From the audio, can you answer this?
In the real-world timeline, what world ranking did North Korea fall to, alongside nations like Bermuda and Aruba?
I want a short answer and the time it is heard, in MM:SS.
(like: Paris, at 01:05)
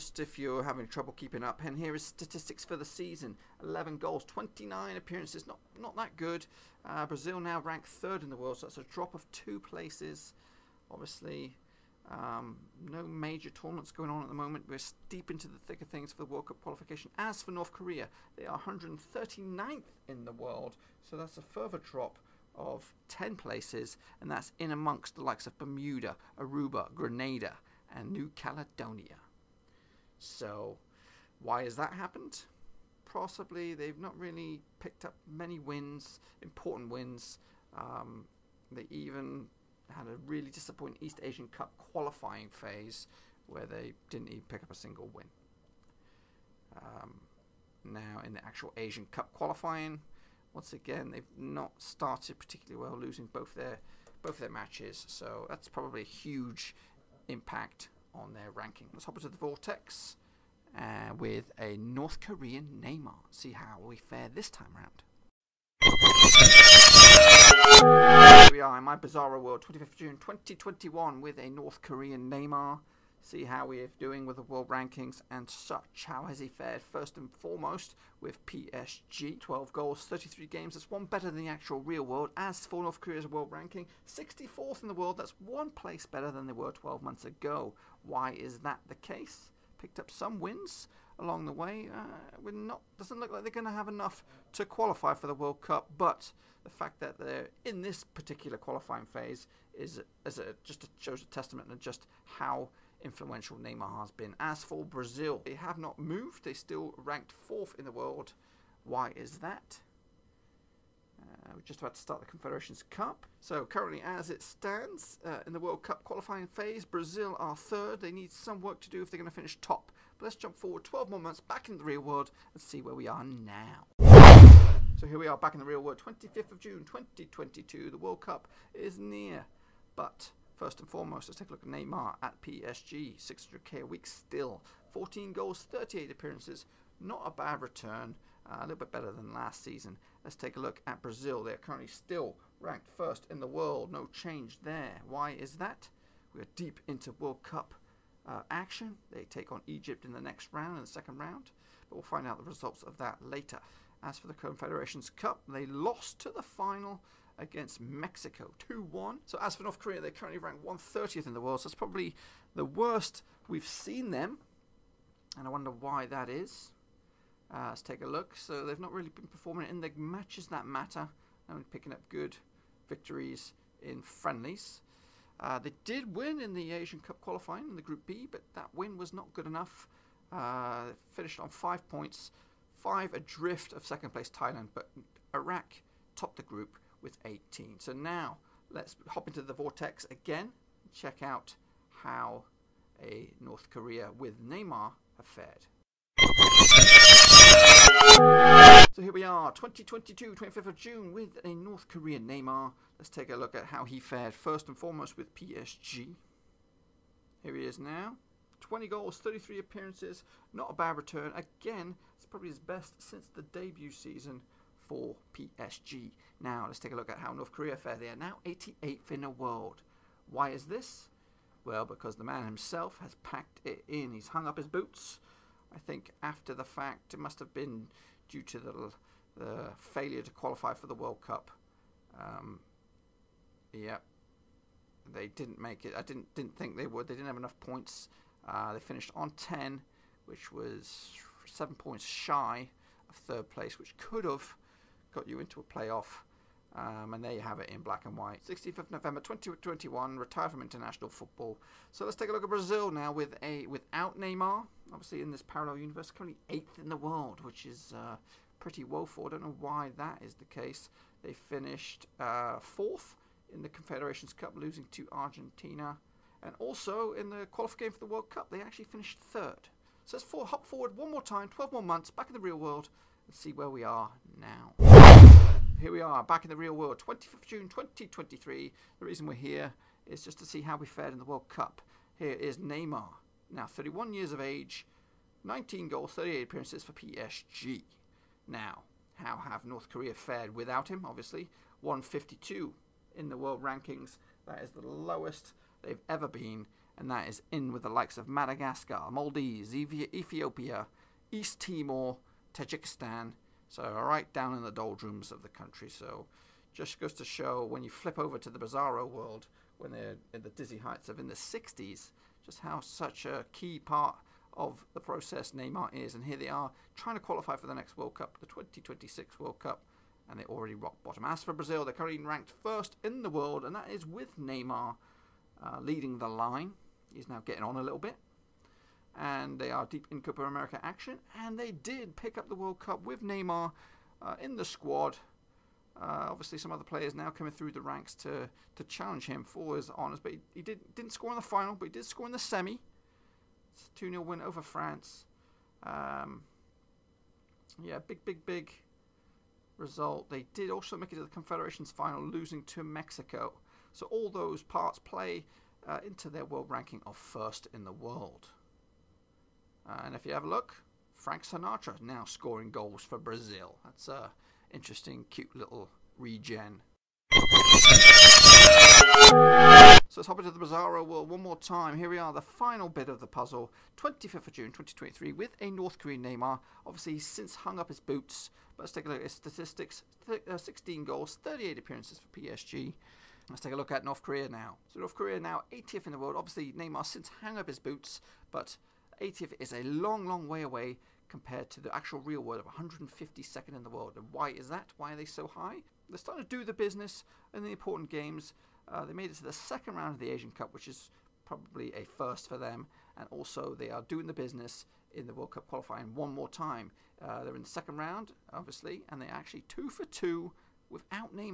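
139th, at 00:18.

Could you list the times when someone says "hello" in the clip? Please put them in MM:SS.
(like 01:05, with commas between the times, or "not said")
not said.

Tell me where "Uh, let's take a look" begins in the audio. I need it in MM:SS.
02:47.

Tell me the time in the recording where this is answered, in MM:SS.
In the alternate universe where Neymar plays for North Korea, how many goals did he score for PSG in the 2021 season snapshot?
01:19.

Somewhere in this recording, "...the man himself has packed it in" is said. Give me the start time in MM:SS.
03:42.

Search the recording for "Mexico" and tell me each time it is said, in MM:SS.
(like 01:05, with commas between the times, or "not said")
02:37, 05:52.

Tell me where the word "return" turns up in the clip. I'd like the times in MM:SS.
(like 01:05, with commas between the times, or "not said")
02:17, 03:30.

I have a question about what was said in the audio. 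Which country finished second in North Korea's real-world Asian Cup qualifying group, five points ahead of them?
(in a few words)
Thailand.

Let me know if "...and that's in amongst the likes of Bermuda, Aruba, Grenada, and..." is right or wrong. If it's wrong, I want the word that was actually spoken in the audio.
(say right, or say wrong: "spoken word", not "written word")
right.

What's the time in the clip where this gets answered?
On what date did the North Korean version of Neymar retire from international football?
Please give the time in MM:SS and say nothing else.
04:08.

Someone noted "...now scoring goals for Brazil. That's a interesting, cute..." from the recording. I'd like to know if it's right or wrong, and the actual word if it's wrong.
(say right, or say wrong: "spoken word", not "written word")
right.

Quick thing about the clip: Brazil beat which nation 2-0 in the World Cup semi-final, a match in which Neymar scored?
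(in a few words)
France.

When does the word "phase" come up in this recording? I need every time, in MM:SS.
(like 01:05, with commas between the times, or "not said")
00:42, 01:39, 01:56.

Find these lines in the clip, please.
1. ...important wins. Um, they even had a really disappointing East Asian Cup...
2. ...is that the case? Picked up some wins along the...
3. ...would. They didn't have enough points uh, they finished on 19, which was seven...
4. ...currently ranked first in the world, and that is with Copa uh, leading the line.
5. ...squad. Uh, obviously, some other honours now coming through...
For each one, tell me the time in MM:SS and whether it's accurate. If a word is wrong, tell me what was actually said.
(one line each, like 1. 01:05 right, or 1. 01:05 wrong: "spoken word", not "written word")
1. 00:36 right
2. 01:28 right
3. 03:56 wrong: "10", not "19"
4. 05:21 wrong: "Neymar", not "Copa"
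5. 05:34 wrong: "players", not "honours".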